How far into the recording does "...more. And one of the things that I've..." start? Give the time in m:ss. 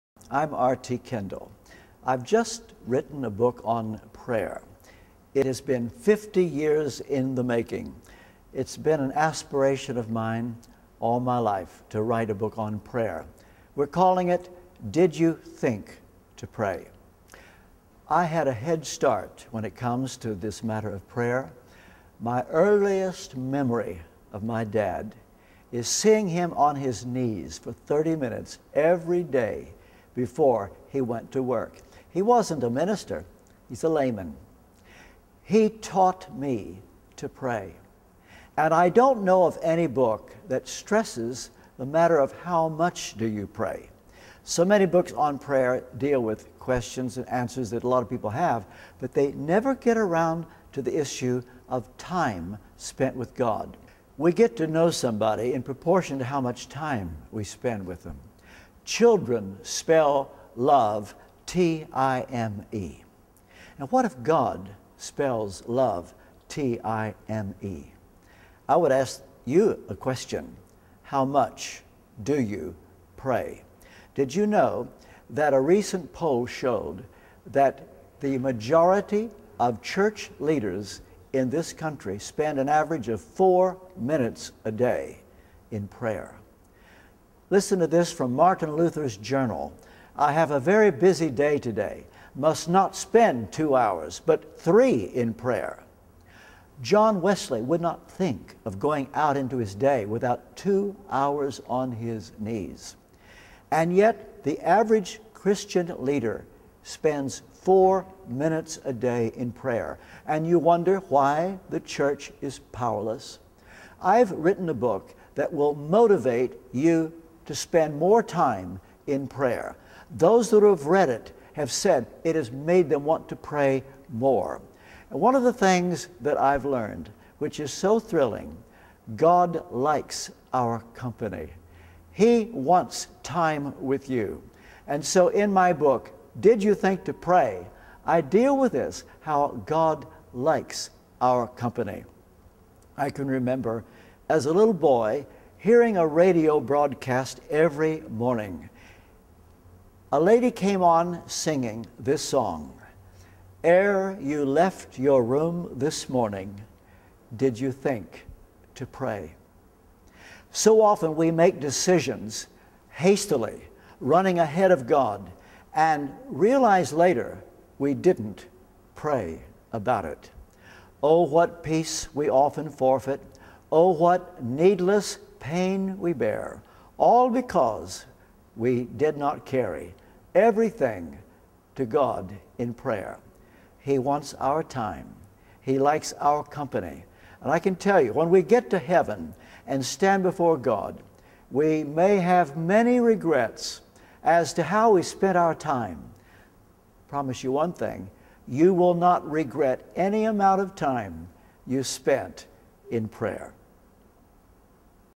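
2:04.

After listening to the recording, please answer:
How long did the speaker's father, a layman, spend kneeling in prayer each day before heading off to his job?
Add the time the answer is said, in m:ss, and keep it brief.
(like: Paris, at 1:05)
30 minutes, at 0:27.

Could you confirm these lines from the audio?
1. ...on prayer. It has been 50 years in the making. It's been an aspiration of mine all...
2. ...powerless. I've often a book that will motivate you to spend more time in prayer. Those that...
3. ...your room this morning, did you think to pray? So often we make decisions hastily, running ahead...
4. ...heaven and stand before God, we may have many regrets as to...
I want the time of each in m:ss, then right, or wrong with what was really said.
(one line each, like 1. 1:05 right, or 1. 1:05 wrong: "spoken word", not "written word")
1. 0:03 right
2. 1:52 wrong: "written", not "often"
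3. 2:34 right
4. 3:08 right.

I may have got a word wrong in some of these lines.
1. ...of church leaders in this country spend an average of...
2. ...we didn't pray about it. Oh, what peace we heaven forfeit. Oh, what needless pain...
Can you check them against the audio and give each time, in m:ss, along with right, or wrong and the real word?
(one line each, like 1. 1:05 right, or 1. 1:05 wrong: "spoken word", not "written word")
1. 1:19 right
2. 2:47 wrong: "often", not "heaven".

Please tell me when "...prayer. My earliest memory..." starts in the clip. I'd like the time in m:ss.
0:21.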